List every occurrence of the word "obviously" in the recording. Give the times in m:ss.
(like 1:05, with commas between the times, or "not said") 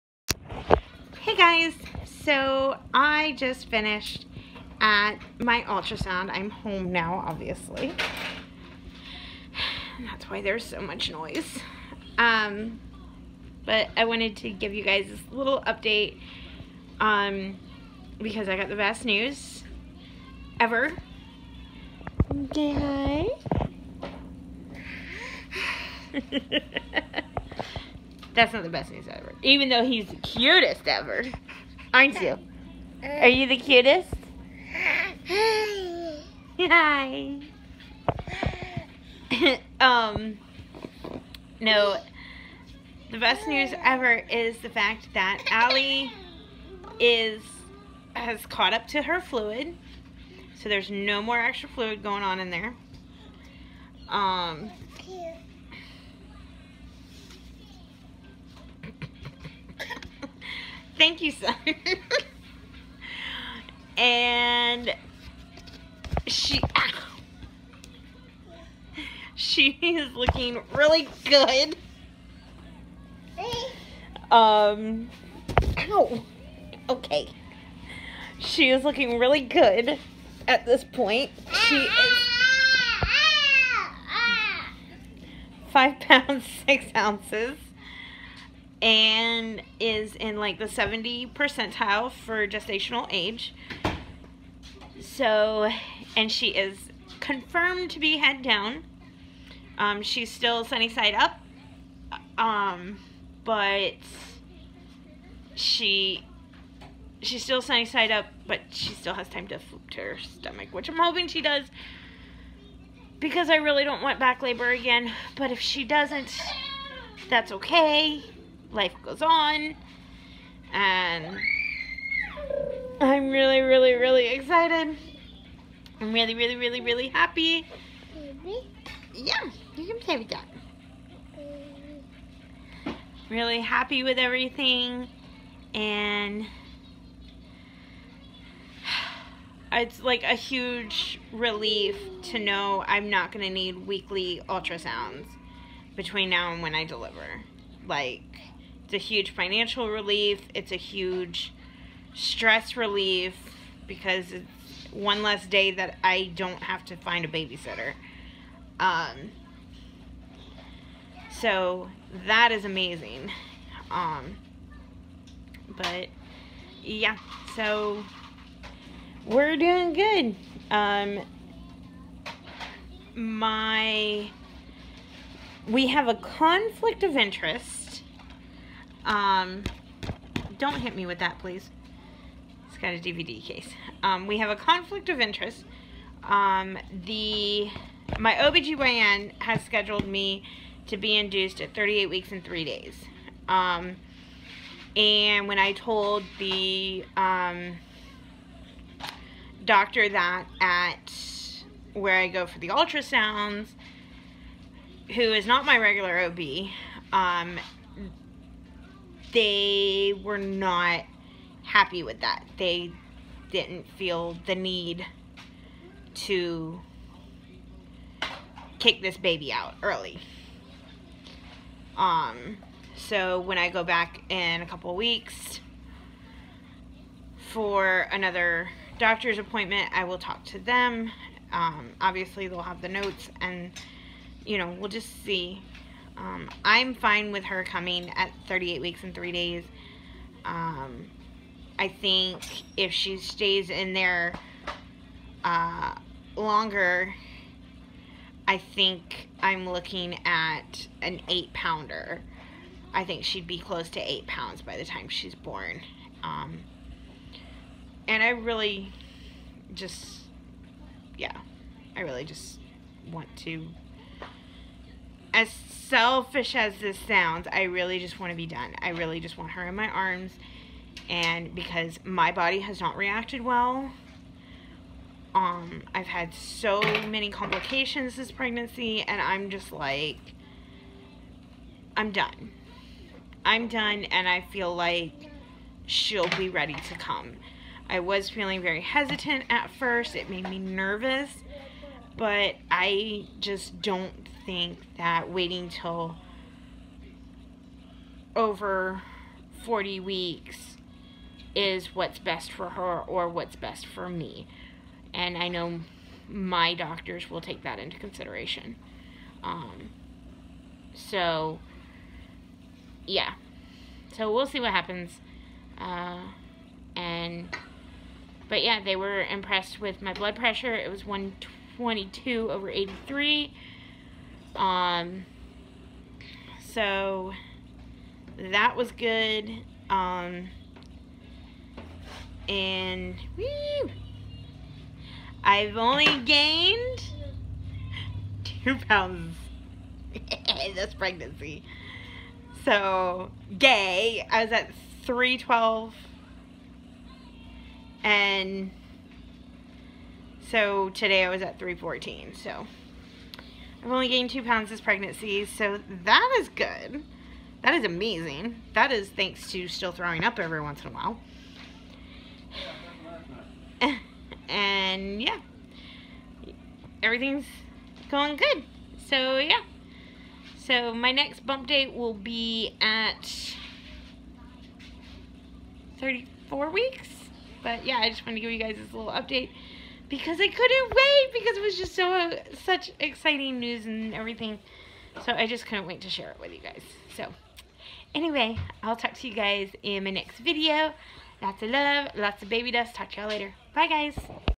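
0:07, 3:51.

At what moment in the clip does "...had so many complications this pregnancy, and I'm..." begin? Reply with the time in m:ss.
4:36.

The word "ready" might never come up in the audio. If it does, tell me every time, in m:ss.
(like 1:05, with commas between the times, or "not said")
4:46.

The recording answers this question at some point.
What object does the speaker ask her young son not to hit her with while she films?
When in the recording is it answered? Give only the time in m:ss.
3:02.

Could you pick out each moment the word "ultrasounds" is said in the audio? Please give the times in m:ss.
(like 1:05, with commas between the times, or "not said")
0:05, 2:24, 3:22.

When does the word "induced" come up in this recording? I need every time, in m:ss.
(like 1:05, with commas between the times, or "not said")
3:11.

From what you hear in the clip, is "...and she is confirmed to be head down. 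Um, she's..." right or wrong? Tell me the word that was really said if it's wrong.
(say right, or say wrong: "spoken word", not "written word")
right.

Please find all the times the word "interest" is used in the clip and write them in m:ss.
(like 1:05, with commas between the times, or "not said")
2:57, 3:05.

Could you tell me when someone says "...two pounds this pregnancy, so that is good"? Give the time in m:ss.
5:54.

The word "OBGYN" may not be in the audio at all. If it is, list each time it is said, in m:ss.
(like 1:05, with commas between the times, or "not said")
3:08.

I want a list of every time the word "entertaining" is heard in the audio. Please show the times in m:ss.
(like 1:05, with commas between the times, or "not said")
not said.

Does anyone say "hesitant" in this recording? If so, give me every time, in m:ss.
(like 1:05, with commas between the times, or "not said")
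4:48.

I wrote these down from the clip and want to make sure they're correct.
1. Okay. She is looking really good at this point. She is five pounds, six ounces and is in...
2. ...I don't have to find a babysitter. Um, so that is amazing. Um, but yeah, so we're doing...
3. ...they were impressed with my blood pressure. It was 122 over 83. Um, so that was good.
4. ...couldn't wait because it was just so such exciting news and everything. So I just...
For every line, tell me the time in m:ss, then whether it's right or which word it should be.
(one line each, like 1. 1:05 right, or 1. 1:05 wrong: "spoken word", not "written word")
1. 1:16 right
2. 2:36 right
3. 5:18 right
4. 6:20 right.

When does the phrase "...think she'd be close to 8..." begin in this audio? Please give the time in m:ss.
4:13.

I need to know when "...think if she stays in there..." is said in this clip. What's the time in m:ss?
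4:01.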